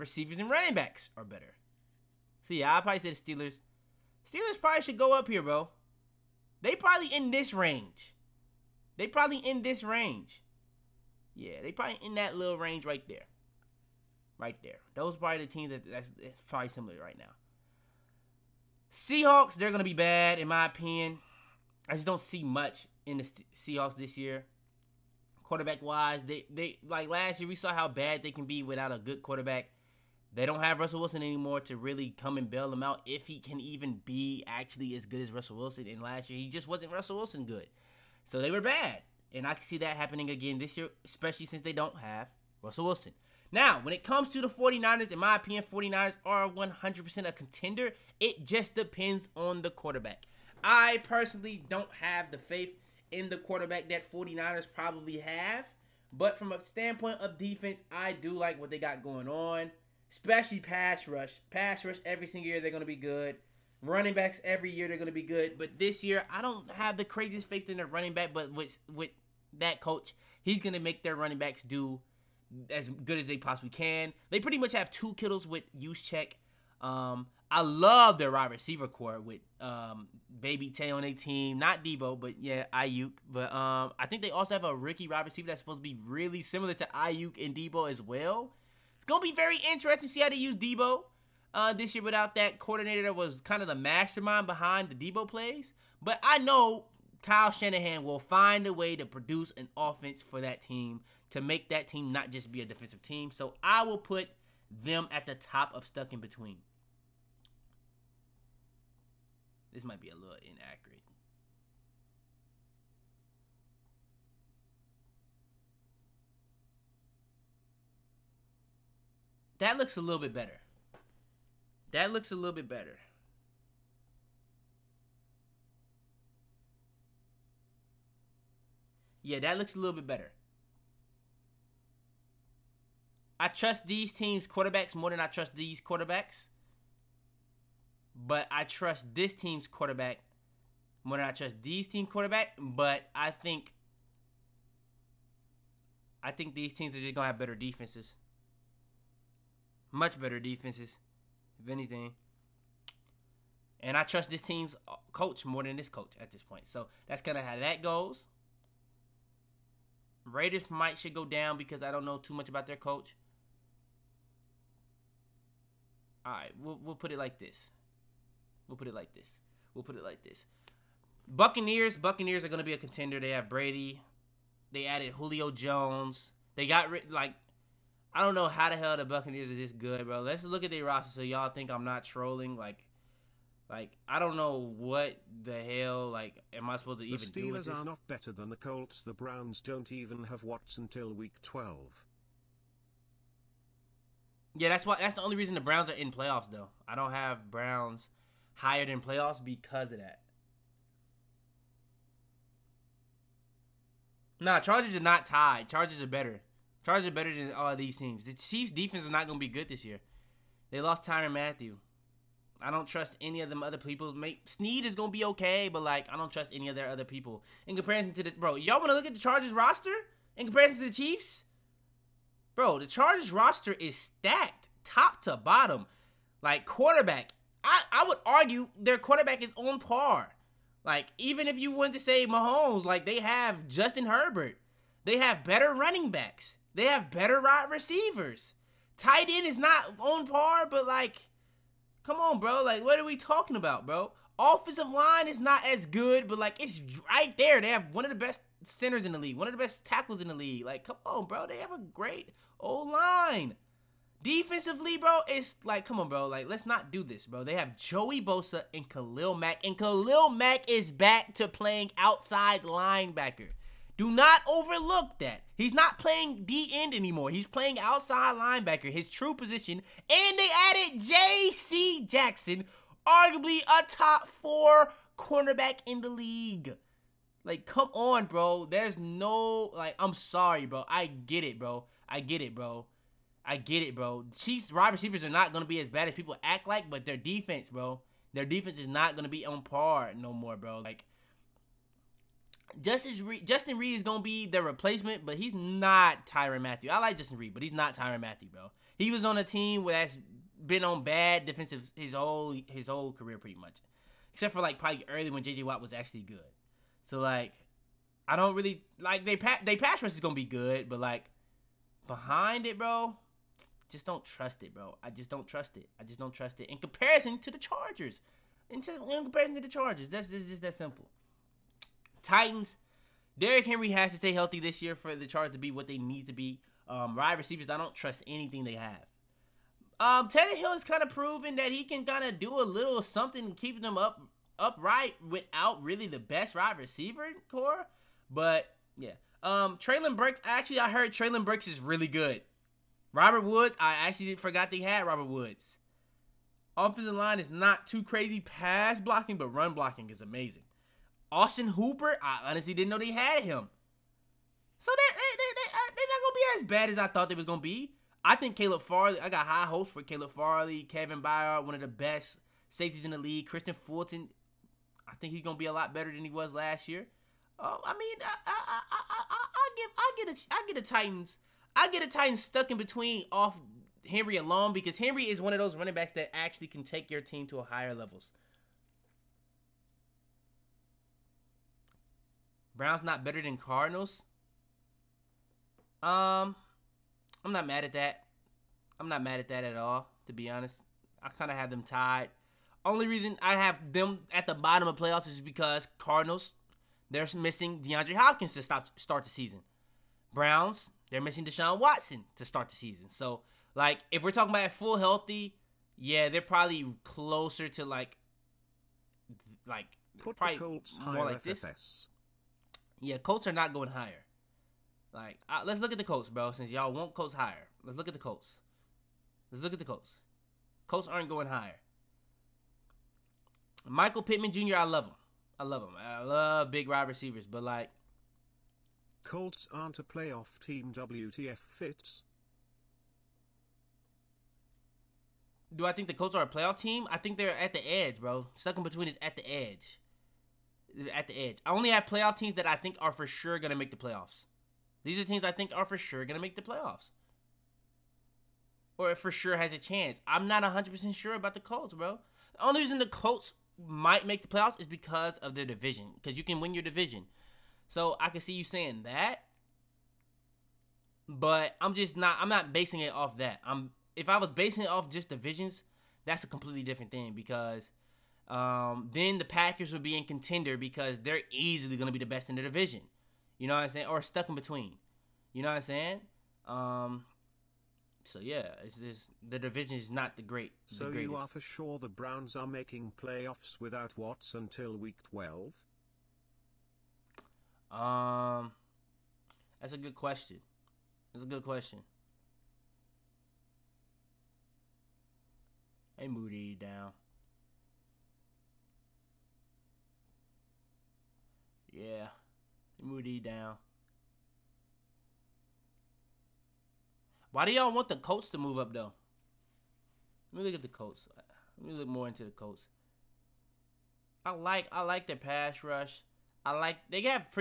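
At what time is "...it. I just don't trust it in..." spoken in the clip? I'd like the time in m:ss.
5:15.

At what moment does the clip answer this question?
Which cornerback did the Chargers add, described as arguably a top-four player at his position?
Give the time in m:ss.
4:31.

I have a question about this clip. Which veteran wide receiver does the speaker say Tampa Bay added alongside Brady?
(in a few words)
Julio Jones.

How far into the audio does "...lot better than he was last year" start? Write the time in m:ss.
6:05.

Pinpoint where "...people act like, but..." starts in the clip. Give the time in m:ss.
4:46.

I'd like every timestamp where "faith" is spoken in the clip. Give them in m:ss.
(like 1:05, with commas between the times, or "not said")
0:52, 1:07.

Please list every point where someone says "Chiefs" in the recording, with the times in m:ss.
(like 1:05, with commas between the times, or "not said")
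3:28, 3:40, 4:44.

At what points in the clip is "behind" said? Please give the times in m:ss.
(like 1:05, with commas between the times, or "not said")
1:34, 5:12.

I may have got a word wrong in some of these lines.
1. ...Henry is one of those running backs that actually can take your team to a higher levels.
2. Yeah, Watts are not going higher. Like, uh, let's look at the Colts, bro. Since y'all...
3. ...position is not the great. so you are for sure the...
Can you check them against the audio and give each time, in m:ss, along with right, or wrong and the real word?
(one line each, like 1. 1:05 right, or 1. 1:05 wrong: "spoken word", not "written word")
1. 6:14 right
2. 6:53 wrong: "Colts", not "Watts"
3. 7:59 wrong: "division", not "position".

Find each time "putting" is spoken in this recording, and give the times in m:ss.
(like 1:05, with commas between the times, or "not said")
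not said.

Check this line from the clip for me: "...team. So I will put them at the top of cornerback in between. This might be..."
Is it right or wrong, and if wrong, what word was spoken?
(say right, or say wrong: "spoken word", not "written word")
wrong: "stuck", not "cornerback".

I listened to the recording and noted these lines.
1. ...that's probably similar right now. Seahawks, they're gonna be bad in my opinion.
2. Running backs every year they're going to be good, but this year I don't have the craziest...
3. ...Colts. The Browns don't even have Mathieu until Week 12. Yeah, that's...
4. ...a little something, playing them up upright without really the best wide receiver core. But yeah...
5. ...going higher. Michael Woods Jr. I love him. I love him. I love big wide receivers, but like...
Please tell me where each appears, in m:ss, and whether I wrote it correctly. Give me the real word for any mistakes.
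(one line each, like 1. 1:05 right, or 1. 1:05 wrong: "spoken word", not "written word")
1. 0:16 right
2. 1:03 right
3. 3:08 wrong: "Watts", not "Mathieu"
4. 5:32 wrong: "keeping", not "playing"
5. 7:01 wrong: "Pittman", not "Woods".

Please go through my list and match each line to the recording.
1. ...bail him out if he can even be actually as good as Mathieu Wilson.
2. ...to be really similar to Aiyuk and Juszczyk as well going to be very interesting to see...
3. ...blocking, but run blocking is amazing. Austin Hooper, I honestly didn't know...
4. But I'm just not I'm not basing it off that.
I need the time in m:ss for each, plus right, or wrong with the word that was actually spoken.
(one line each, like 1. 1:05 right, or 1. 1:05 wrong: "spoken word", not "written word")
1. 0:32 wrong: "Russell", not "Mathieu"
2. 1:25 wrong: "Deebo", not "Juszczyk"
3. 5:49 right
4. 7:41 right.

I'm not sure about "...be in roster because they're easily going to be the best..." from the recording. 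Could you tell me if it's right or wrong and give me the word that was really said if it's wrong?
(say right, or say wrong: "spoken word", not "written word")
wrong: "contender", not "roster".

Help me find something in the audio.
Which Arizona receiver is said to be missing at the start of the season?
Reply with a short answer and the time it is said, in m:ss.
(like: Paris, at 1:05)
DeAndre Hopkins, at 6:37.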